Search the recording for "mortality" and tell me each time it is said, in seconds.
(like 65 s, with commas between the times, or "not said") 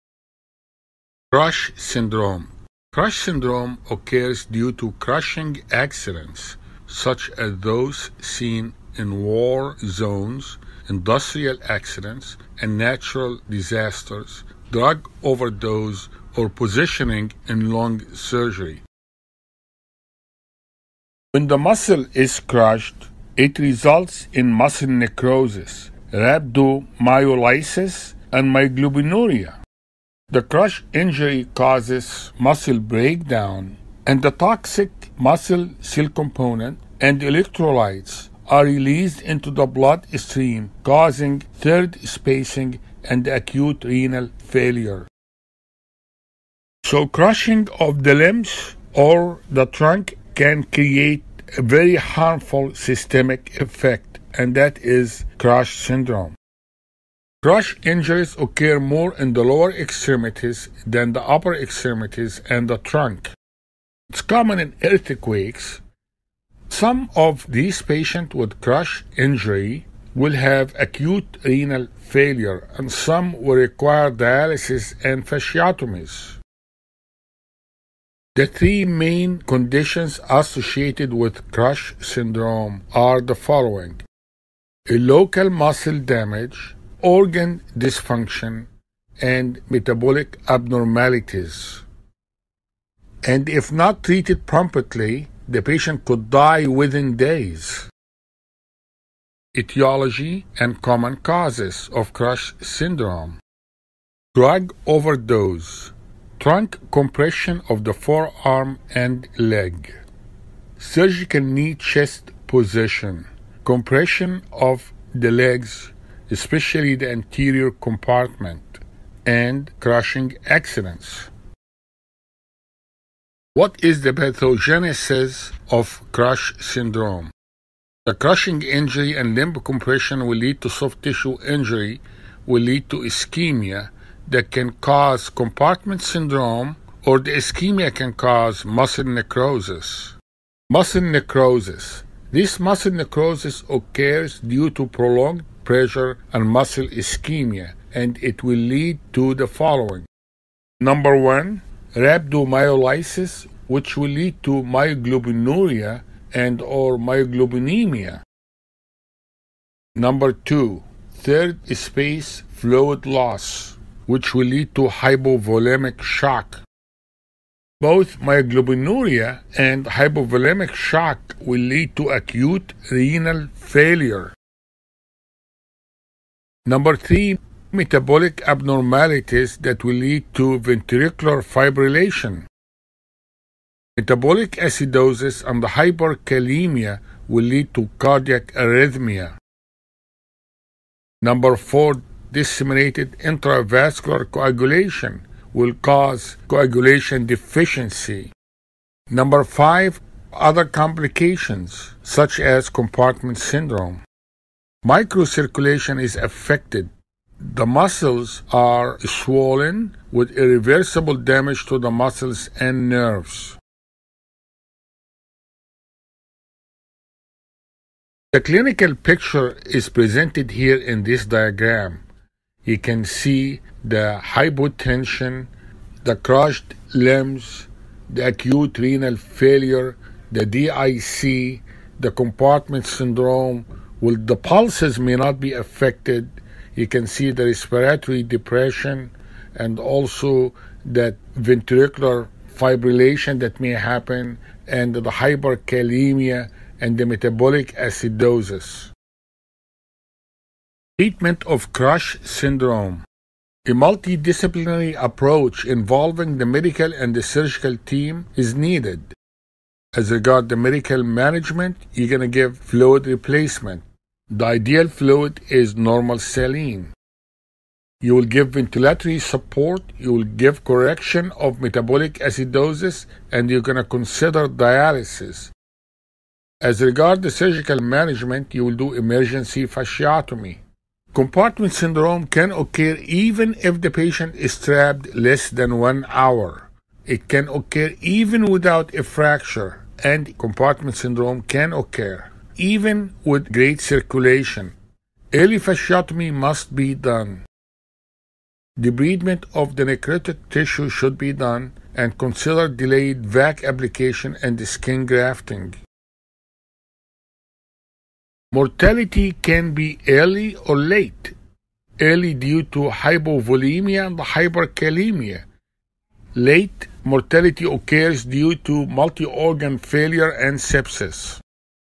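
308 s, 317 s.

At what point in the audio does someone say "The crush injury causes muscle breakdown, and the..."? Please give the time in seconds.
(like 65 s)
30 s.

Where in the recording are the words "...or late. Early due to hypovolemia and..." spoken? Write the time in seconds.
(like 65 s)
310 s.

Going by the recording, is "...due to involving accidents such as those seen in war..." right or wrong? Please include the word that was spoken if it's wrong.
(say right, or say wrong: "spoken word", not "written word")
wrong: "crushing", not "involving".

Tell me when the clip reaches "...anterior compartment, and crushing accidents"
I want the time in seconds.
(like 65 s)
117 s.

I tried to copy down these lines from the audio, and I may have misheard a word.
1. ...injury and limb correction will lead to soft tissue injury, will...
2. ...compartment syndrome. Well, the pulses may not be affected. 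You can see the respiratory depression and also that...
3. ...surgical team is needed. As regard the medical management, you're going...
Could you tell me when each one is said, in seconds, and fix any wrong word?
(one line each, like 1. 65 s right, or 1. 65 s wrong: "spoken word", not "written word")
1. 128 s wrong: "compression", not "correction"
2. 232 s right
3. 257 s right.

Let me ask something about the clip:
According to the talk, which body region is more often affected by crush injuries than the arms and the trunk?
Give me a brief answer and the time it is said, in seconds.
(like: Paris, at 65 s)
lower extremities, at 59 s.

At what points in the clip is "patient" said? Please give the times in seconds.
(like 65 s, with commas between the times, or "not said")
67 s, 95 s, 283 s.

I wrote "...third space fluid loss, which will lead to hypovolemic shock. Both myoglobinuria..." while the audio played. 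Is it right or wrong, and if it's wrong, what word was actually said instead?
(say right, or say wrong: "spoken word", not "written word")
right.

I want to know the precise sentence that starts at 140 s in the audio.
Muscle necrosis this muscle necrosis occurs due to prolonged pressure and muscle ischemia, and it will lead to the following.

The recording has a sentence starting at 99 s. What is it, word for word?
Etiology and common causes of crush syndrome.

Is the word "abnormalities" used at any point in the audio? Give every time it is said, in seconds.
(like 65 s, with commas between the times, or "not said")
90 s, 178 s.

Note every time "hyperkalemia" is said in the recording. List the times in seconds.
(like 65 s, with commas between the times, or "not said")
185 s, 245 s, 314 s.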